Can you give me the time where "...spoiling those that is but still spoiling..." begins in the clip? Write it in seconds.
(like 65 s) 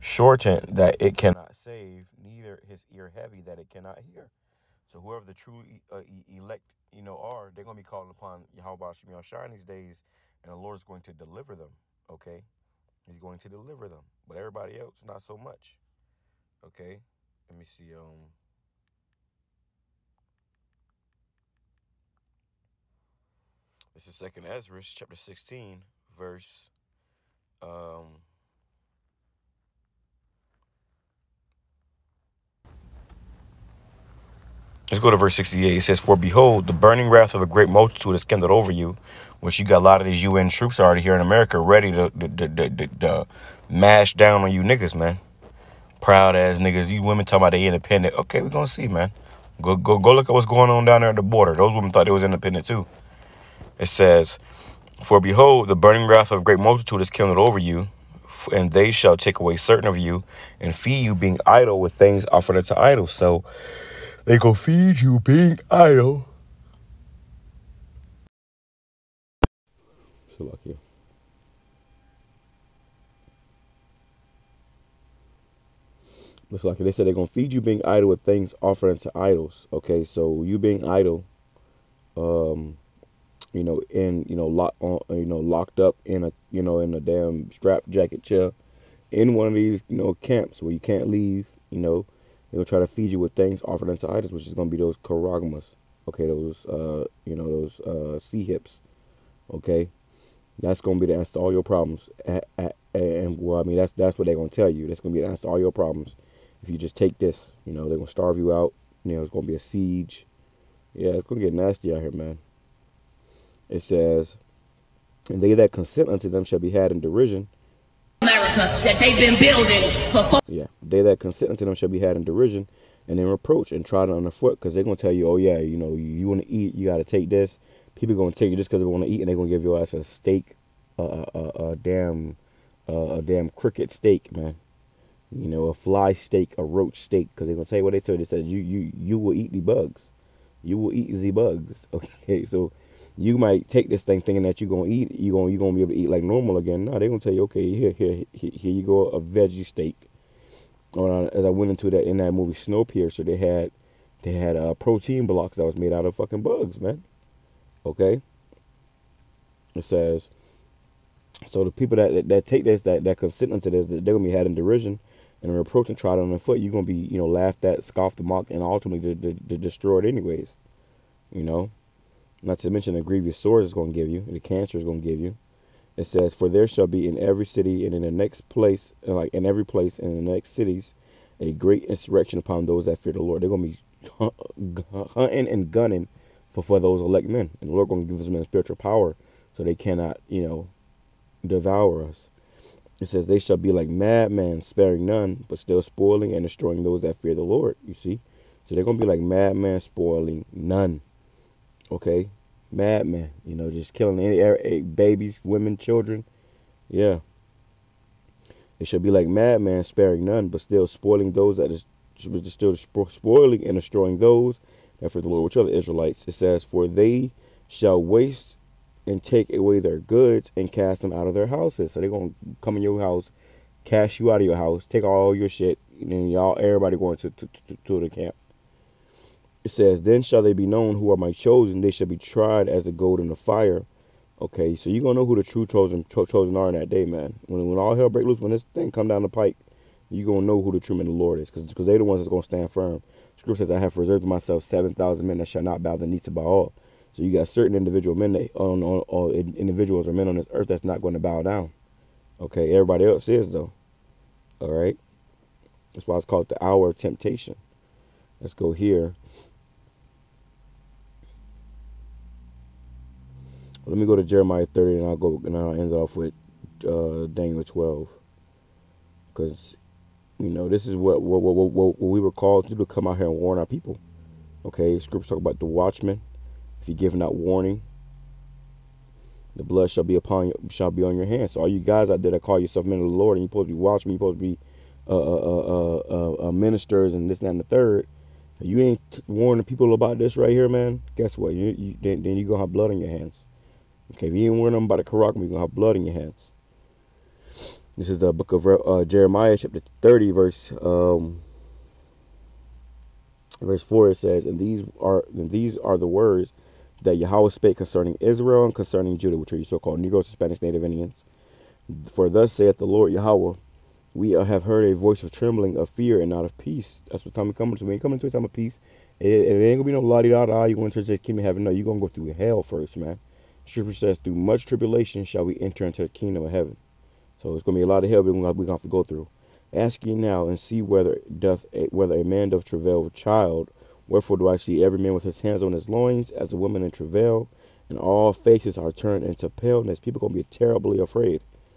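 210 s.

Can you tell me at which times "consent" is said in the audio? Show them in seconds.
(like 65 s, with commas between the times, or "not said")
115 s, 121 s, 163 s.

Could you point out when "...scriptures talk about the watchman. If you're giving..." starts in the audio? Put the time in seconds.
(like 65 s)
274 s.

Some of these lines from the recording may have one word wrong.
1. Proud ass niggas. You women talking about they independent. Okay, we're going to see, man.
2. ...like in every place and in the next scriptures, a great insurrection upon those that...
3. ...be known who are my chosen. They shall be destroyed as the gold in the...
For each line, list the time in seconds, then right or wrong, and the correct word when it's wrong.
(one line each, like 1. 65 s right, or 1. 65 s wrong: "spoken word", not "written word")
1. 46 s right
2. 179 s wrong: "cities", not "scriptures"
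3. 230 s wrong: "tried", not "destroyed".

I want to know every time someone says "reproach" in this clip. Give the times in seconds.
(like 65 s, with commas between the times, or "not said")
123 s, 165 s.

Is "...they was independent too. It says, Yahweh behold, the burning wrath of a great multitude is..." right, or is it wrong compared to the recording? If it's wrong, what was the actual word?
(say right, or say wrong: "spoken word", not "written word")
wrong: "For", not "Yahweh".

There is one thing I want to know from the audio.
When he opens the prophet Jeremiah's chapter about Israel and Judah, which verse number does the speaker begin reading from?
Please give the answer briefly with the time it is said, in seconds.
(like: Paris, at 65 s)
4, at 303 s.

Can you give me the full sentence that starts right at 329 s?
Ask ye now and see whether doth a, whether a man doth travail with child.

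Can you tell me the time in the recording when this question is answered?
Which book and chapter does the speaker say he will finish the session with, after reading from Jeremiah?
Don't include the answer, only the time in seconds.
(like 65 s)
267 s.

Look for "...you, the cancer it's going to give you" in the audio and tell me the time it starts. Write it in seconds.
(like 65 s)
174 s.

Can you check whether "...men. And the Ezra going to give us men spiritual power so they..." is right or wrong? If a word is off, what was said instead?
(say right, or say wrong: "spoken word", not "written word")
wrong: "Lord", not "Ezra".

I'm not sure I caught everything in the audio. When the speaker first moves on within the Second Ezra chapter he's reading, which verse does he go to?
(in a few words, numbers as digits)
68.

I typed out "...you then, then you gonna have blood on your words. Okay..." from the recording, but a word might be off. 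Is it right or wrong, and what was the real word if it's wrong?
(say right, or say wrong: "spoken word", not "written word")
wrong: "hands", not "words".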